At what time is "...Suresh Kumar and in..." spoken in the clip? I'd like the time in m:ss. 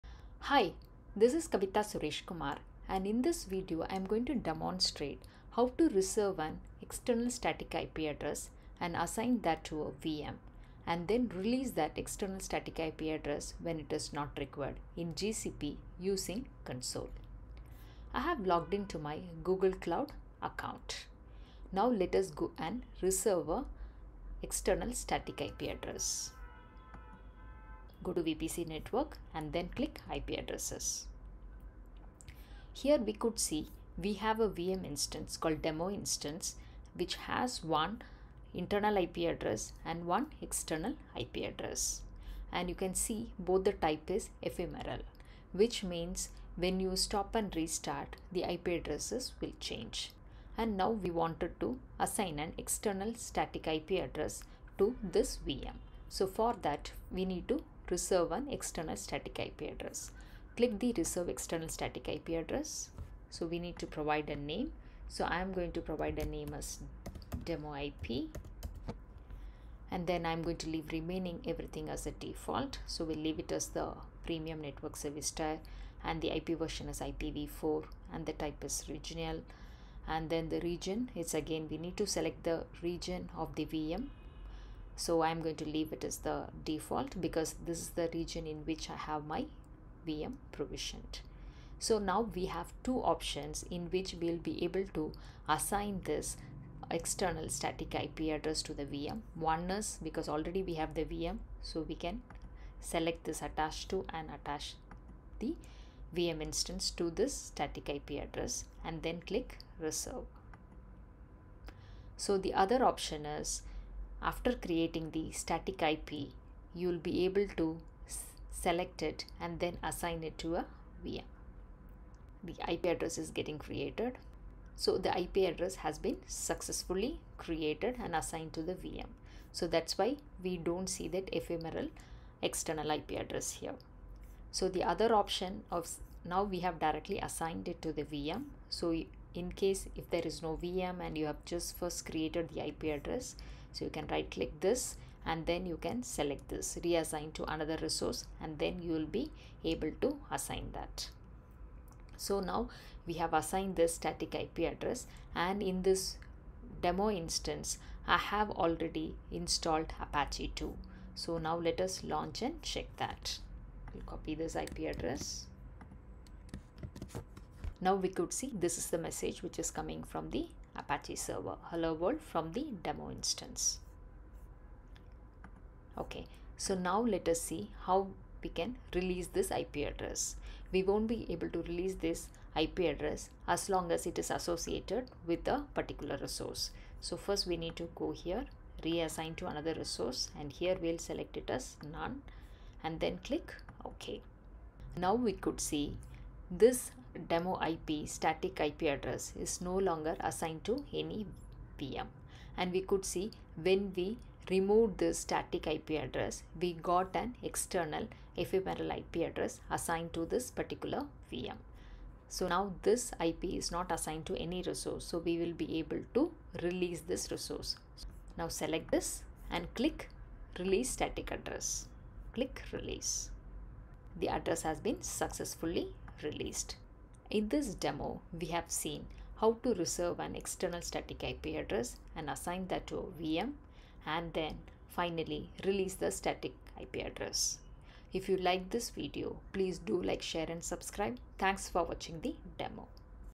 0:01.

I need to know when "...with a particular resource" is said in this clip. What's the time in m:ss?
3:05.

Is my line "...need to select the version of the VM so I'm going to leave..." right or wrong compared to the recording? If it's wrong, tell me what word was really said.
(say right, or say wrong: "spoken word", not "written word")
wrong: "region", not "version".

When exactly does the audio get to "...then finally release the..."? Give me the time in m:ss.
3:54.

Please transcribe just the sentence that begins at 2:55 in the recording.
Okay, so now let us see how we can release this IP address.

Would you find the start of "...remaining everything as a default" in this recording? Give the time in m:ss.
1:10.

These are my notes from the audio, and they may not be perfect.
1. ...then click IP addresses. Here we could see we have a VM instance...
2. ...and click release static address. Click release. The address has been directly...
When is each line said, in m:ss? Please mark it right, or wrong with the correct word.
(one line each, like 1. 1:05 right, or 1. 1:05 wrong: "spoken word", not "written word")
1. 0:29 right
2. 3:39 wrong: "successfully", not "directly".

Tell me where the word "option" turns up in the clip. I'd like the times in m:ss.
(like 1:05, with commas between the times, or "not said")
1:33, 1:52, 2:15.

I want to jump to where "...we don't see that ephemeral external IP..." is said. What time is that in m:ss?
2:10.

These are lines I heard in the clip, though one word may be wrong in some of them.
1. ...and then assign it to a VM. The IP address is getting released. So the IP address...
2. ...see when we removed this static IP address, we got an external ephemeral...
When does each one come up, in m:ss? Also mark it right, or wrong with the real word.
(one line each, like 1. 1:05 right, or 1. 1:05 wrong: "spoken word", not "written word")
1. 1:59 wrong: "created", not "released"
2. 3:23 right.